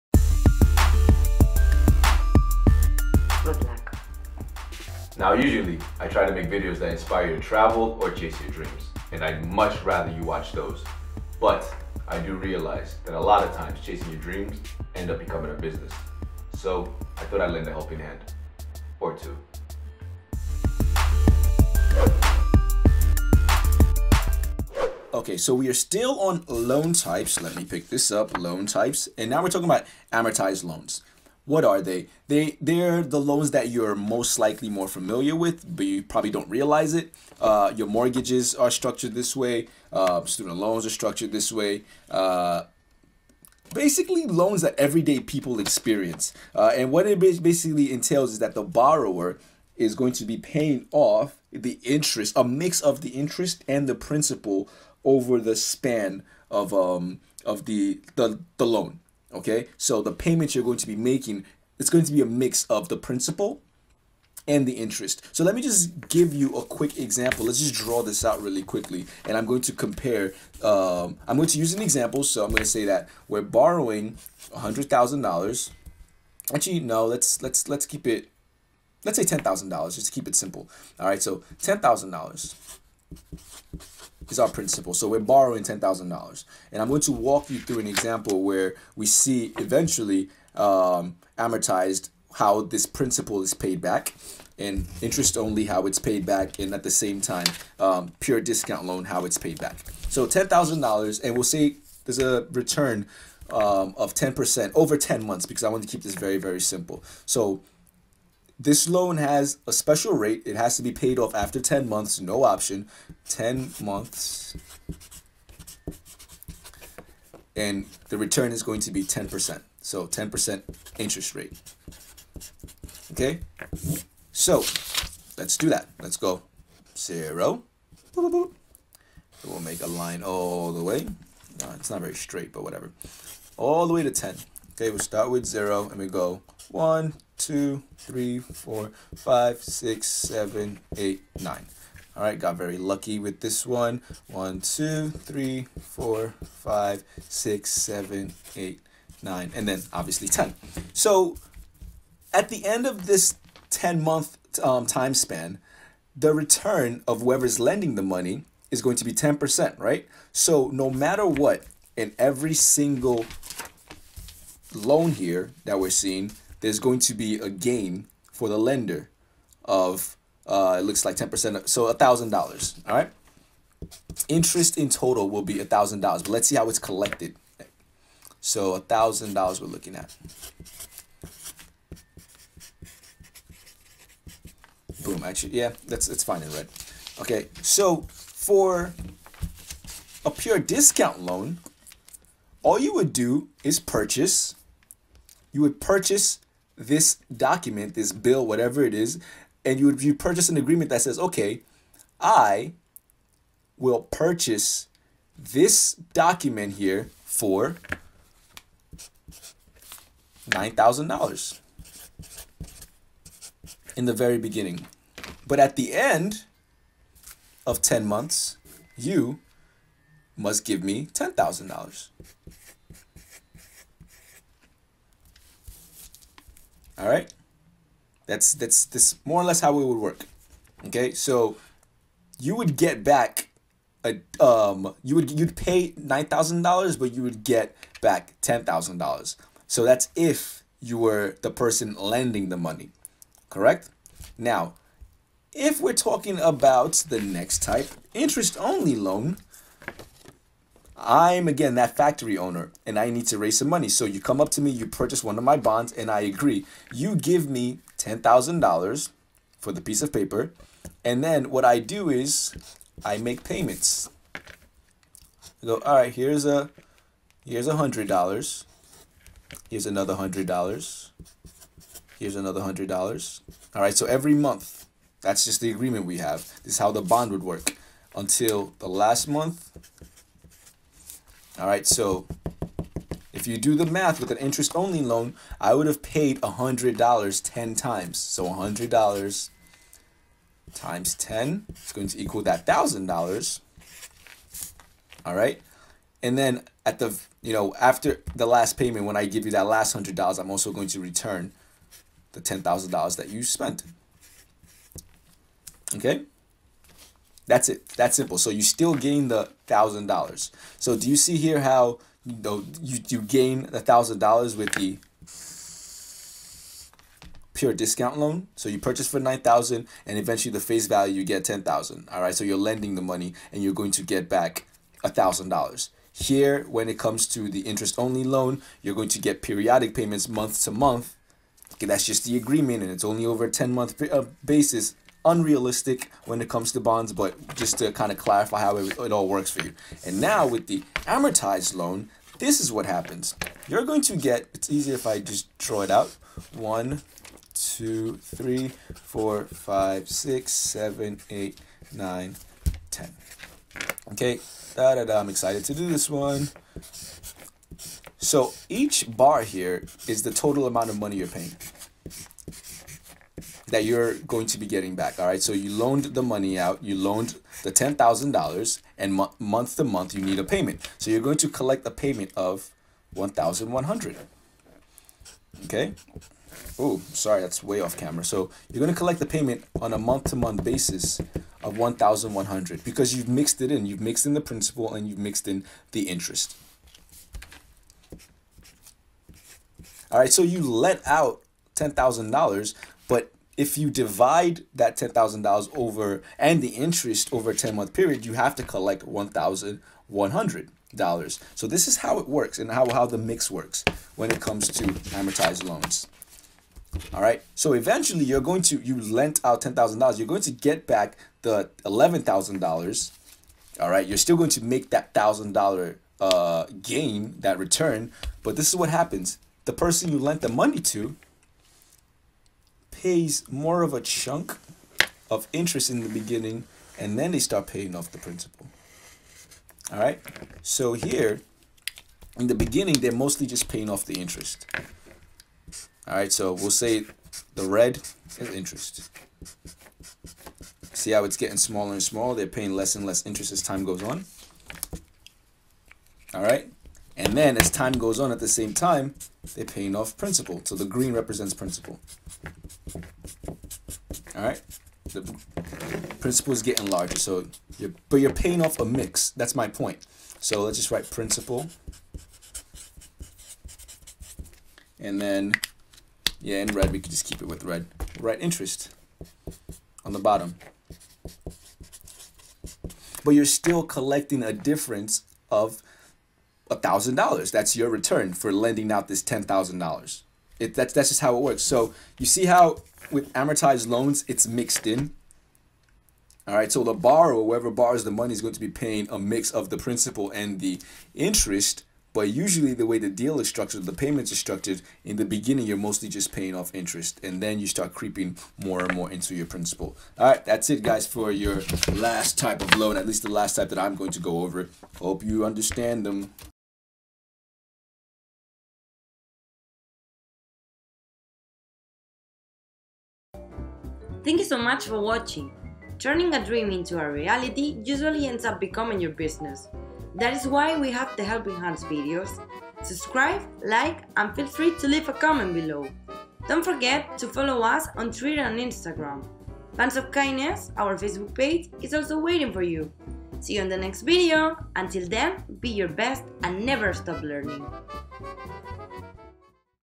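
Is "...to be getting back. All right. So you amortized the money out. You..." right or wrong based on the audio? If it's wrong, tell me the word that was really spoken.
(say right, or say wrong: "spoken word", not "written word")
wrong: "loaned", not "amortized".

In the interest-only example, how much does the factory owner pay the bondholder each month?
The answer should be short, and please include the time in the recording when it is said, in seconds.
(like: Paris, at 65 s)
$100, at 267 s.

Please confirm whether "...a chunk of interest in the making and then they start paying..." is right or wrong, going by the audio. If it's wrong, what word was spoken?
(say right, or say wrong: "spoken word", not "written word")
wrong: "beginning", not "making".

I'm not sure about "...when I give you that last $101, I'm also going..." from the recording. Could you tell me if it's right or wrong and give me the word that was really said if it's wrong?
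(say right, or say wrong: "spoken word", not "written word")
wrong: "100", not "101".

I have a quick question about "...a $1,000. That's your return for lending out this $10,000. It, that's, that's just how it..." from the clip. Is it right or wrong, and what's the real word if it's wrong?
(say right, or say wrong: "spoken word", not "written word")
right.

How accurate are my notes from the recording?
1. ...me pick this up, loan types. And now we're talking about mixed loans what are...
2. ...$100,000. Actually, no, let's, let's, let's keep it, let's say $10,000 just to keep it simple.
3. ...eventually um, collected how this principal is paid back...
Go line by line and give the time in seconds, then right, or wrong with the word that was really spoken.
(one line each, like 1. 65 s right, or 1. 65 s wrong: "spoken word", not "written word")
1. 27 s wrong: "amortized", not "mixed"
2. 74 s right
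3. 89 s wrong: "amortized", not "collected".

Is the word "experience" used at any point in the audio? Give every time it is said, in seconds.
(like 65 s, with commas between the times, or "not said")
45 s.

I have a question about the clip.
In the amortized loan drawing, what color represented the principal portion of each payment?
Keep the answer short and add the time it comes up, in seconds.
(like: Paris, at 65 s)
Green, at 450 s.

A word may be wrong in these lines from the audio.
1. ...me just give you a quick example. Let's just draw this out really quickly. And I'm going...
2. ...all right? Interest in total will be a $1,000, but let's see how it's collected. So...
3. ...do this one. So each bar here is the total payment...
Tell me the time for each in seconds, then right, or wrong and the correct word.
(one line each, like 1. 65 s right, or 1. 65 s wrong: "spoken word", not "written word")
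1. 65 s right
2. 172 s right
3. 355 s wrong: "amount", not "payment".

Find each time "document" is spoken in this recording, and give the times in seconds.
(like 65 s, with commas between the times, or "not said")
197 s, 205 s.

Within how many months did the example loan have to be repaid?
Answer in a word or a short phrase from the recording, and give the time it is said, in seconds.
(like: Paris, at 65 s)
10 months, at 110 s.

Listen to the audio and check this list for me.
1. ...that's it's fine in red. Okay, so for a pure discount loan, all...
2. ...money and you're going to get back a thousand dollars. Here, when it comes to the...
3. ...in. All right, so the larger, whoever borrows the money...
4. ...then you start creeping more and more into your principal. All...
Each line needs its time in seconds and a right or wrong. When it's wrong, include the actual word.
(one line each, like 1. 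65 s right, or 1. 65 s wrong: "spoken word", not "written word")
1. 185 s right
2. 323 s right
3. 484 s wrong: "borrower", not "larger"
4. 497 s right.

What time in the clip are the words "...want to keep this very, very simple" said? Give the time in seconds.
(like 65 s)
105 s.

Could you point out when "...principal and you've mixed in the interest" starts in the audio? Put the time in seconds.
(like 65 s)
384 s.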